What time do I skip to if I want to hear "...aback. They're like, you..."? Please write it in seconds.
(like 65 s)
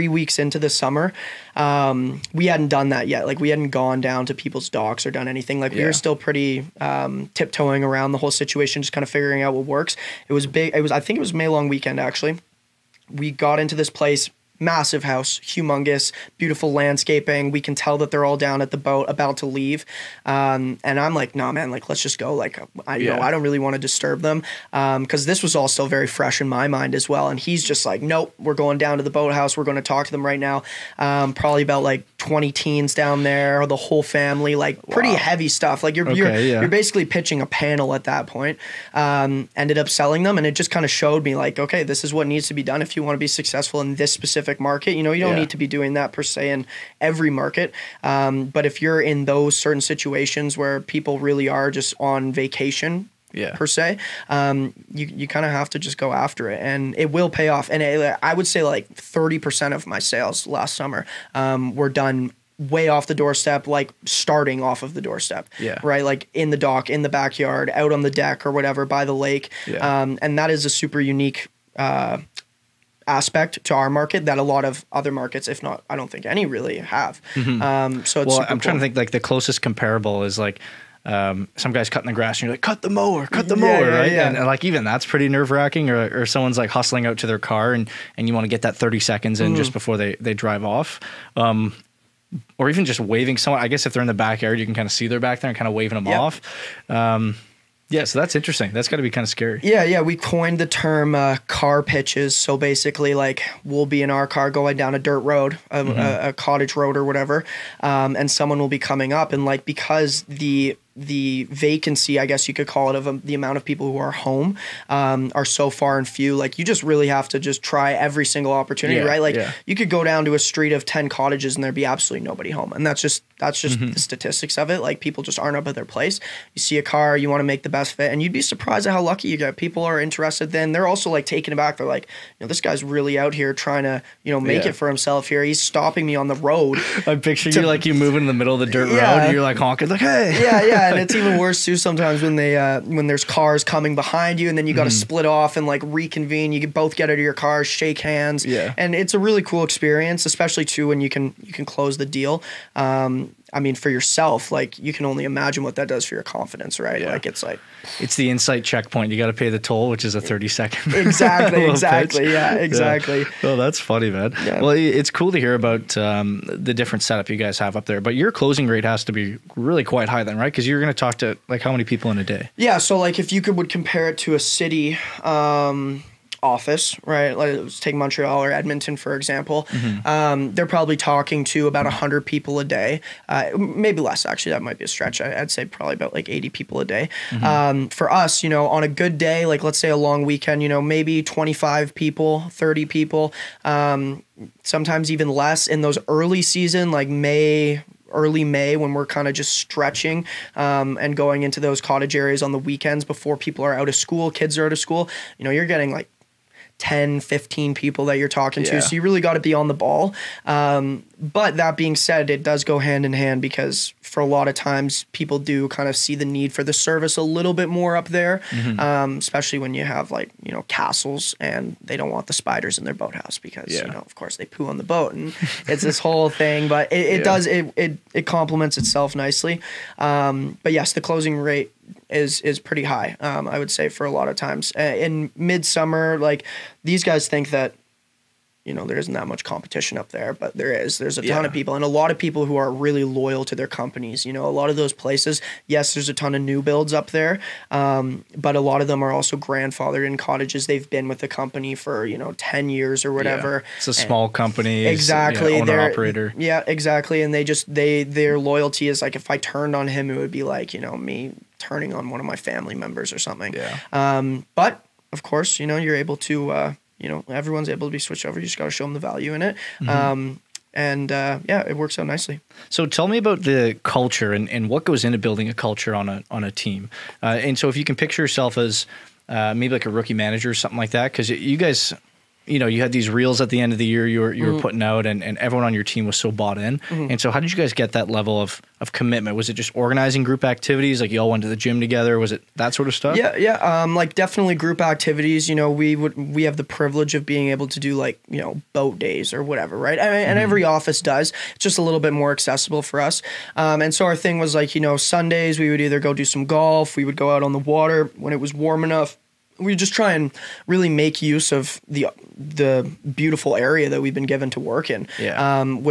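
131 s.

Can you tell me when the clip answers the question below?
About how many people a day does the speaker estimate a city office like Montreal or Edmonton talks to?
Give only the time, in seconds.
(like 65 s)
186 s.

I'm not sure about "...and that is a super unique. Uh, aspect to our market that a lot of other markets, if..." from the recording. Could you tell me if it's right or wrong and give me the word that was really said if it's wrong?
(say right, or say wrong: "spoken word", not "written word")
right.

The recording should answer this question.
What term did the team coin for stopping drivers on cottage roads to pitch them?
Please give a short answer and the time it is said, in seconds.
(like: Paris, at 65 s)
car pitches, at 101 s.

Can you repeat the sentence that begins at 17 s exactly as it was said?
We can tell that they're all down at the boat about to leave.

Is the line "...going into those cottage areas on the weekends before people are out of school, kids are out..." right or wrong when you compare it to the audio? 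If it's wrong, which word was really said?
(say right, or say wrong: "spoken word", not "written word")
right.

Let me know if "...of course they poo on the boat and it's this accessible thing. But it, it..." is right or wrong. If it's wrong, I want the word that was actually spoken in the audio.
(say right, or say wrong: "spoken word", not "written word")
wrong: "whole", not "accessible".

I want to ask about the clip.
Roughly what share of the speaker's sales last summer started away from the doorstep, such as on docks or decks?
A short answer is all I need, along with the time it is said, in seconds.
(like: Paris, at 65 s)
30%, at 58 s.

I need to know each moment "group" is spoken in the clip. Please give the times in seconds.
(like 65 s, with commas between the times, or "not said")
290 s, 294 s.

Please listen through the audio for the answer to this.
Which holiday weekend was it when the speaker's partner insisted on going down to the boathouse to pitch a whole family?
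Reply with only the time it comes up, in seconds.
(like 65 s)
11 s.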